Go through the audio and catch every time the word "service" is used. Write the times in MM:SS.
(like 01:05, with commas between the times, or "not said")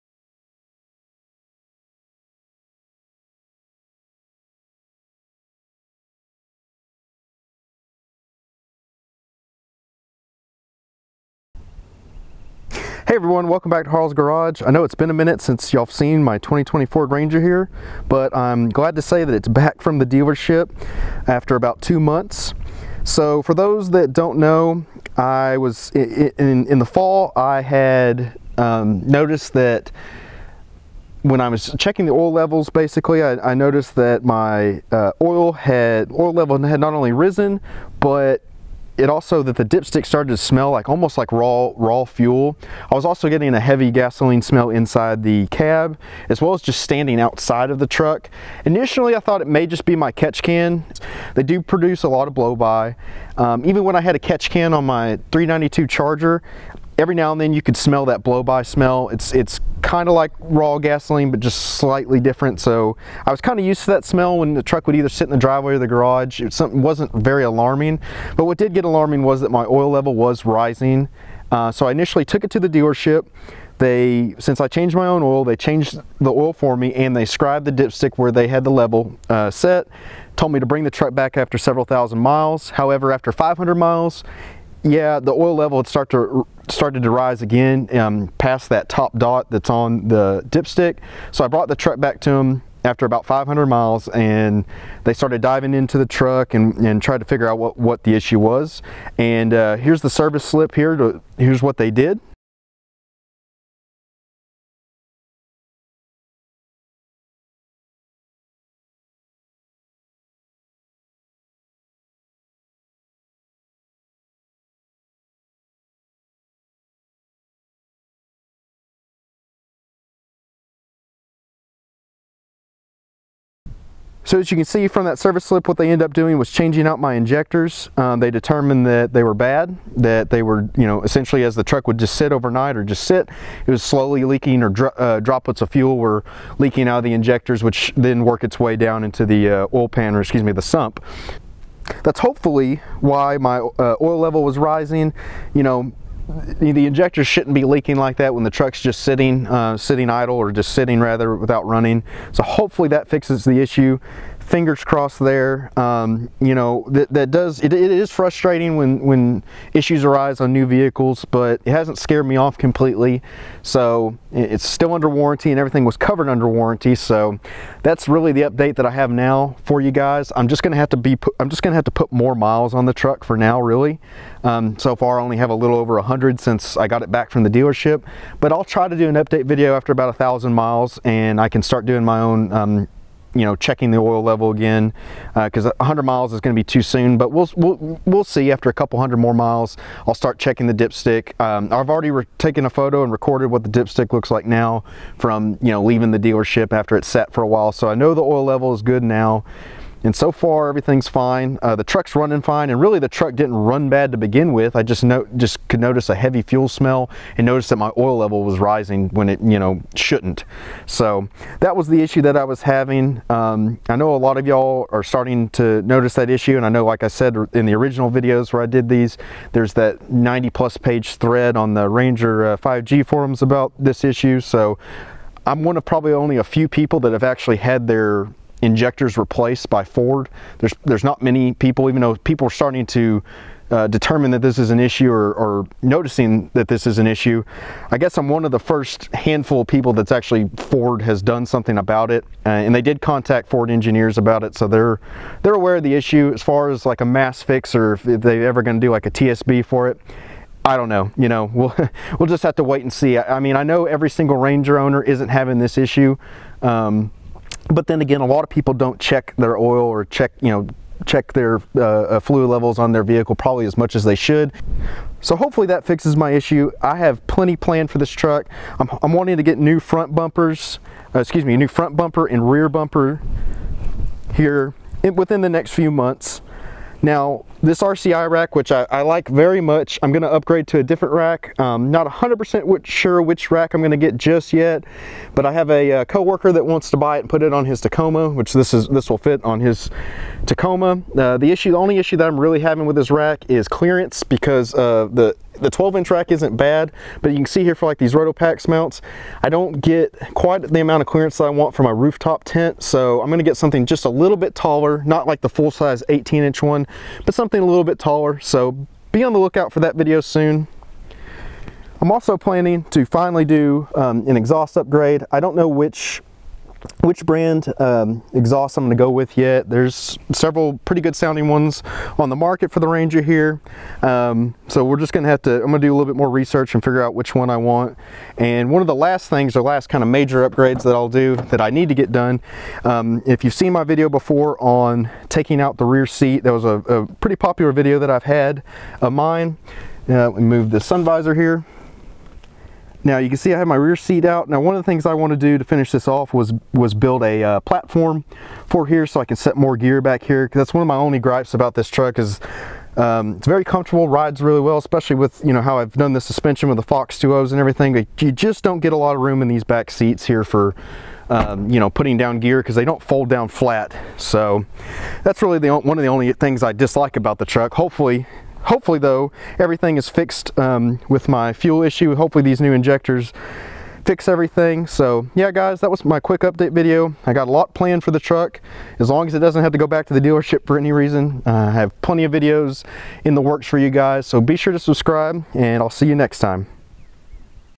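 01:40, 02:05.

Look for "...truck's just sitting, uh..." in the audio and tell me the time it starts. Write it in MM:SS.
02:28.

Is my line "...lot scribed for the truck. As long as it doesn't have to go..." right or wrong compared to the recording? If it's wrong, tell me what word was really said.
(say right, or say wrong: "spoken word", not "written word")
wrong: "planned", not "scribed".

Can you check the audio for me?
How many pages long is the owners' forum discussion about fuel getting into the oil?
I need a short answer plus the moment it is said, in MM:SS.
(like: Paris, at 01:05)
90, at 03:40.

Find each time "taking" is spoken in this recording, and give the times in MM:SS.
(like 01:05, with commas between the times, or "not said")
05:35.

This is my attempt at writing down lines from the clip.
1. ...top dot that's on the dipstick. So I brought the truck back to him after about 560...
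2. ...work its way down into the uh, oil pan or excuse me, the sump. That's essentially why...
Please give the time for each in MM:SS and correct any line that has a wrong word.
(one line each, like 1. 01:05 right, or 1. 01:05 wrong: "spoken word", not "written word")
1. 01:28 wrong: "500", not "560"
2. 02:18 wrong: "hopefully", not "essentially".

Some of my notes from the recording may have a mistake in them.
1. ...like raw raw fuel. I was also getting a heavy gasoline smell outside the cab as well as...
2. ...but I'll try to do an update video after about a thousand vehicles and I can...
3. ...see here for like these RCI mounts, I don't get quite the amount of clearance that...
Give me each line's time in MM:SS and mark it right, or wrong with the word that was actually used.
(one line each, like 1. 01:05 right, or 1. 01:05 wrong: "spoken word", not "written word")
1. 00:41 wrong: "inside", not "outside"
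2. 02:58 wrong: "miles", not "vehicles"
3. 04:57 wrong: "Rotopax", not "RCI".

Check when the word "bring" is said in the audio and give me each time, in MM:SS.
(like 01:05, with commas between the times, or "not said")
01:20.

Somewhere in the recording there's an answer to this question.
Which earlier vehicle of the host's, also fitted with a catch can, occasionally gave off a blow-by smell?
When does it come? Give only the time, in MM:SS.
00:55.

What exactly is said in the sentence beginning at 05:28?
And one of the last things, the last kind of major upgrades that I'll do that I need to get done.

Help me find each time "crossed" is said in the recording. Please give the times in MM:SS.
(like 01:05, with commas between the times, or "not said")
02:34.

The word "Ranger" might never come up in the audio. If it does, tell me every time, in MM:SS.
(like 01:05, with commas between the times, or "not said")
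00:17, 03:41, 04:14, 05:22.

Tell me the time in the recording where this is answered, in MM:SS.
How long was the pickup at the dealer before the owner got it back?
00:21.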